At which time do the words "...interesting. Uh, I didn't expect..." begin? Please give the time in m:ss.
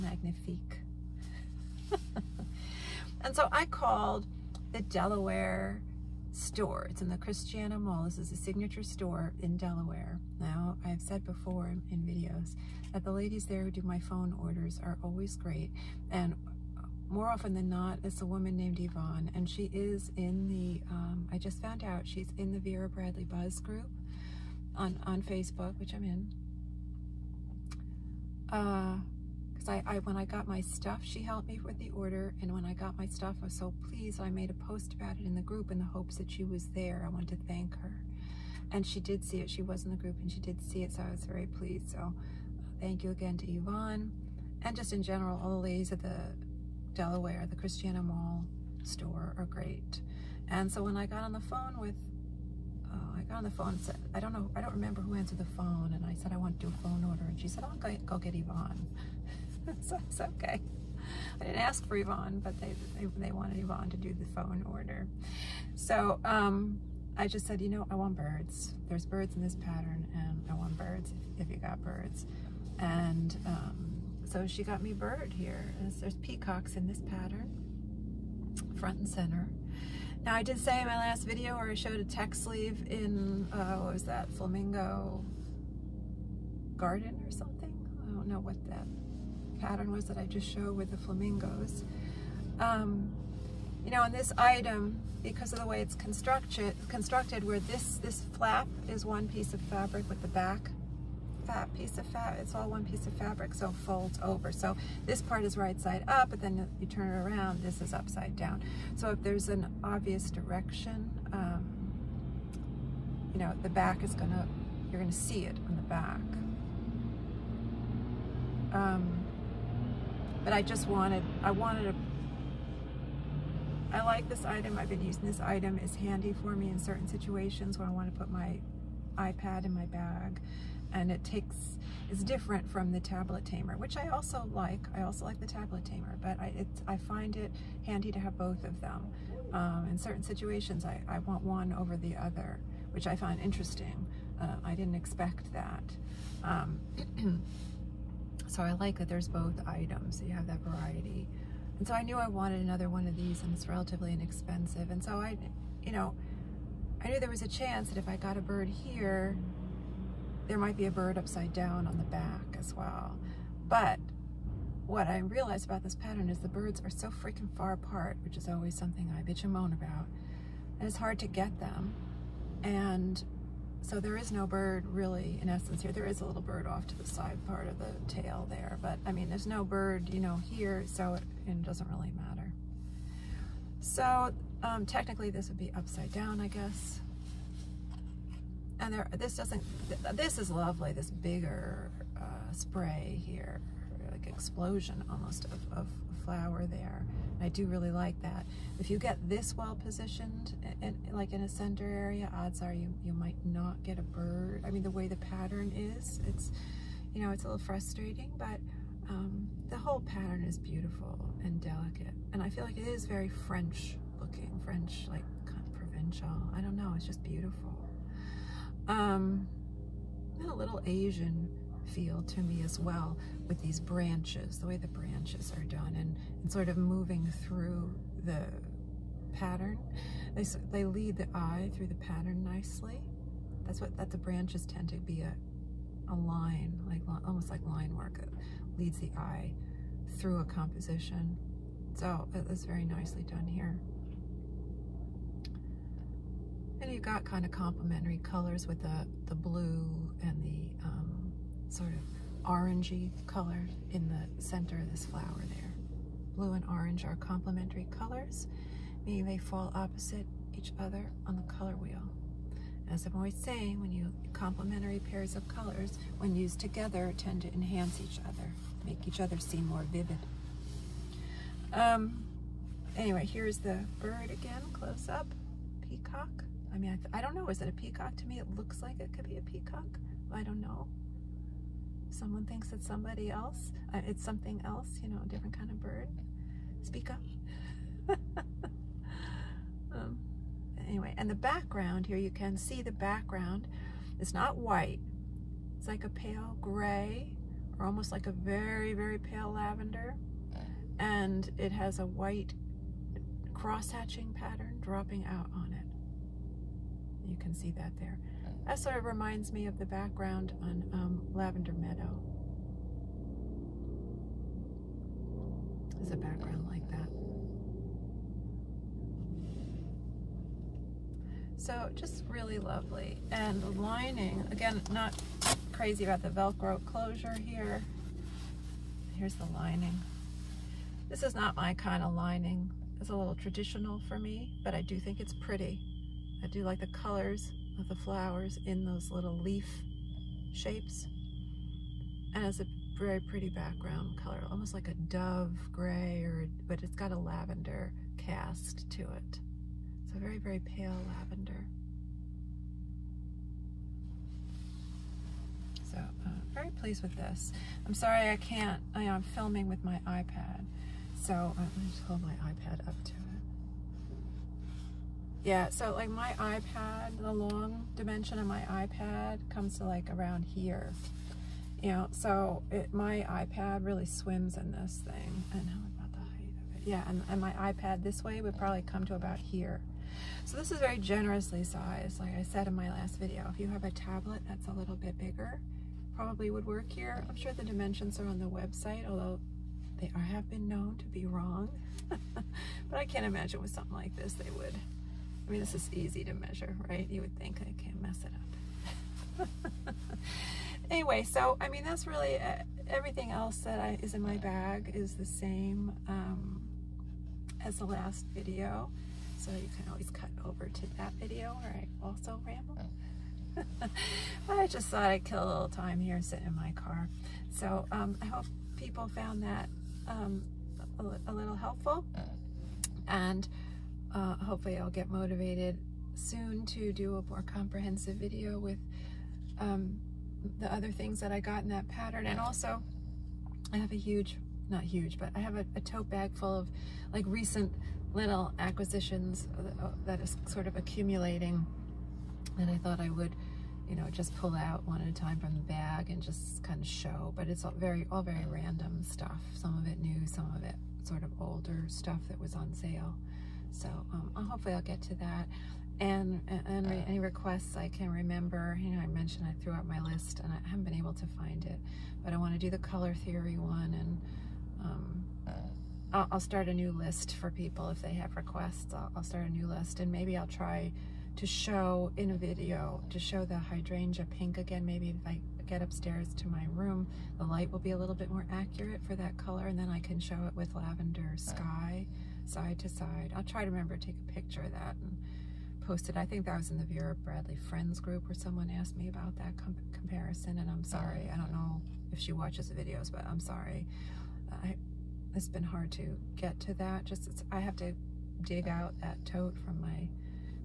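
2:23.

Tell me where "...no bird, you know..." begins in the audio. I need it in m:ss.
2:59.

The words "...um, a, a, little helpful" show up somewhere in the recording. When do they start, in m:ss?
7:00.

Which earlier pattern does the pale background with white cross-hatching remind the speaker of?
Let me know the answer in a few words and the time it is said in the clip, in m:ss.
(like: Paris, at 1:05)
Lavender Meadow, at 5:11.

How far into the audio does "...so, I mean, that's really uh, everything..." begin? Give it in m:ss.
6:41.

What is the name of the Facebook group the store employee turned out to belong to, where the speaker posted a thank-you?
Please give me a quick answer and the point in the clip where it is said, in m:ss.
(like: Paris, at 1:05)
Vera Bradley Buzz, at 0:22.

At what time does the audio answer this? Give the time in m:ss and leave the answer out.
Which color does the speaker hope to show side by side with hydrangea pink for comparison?
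8:00.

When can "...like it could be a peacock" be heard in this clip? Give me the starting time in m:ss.
4:38.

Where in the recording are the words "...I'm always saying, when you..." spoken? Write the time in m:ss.
4:23.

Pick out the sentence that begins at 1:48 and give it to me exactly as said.
So if there's an obvious direction, um, you know, the back is gonna, you're gonna see it on the back.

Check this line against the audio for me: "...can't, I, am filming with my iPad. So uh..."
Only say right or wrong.
right.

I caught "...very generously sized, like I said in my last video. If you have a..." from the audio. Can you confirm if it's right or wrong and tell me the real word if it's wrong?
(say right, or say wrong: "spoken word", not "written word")
right.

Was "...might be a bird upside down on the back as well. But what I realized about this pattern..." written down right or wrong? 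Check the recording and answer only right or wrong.
right.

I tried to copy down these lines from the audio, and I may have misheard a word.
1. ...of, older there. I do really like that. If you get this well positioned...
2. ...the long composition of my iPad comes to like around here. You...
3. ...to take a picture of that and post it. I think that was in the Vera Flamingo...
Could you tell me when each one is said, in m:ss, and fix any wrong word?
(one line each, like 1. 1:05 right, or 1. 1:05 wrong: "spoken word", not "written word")
1. 3:15 wrong: "flower", not "older"
2. 6:07 wrong: "dimension", not "composition"
3. 8:03 wrong: "Bradley", not "Flamingo".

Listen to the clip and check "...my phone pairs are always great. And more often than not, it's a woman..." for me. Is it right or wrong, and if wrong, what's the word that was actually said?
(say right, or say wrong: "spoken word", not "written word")
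wrong: "orders", not "pairs".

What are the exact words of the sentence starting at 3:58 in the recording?
leads the eye through a composition.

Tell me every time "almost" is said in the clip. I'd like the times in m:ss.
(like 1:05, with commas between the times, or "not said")
3:15, 3:57, 4:57, 5:44.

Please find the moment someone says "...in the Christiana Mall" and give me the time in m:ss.
0:07.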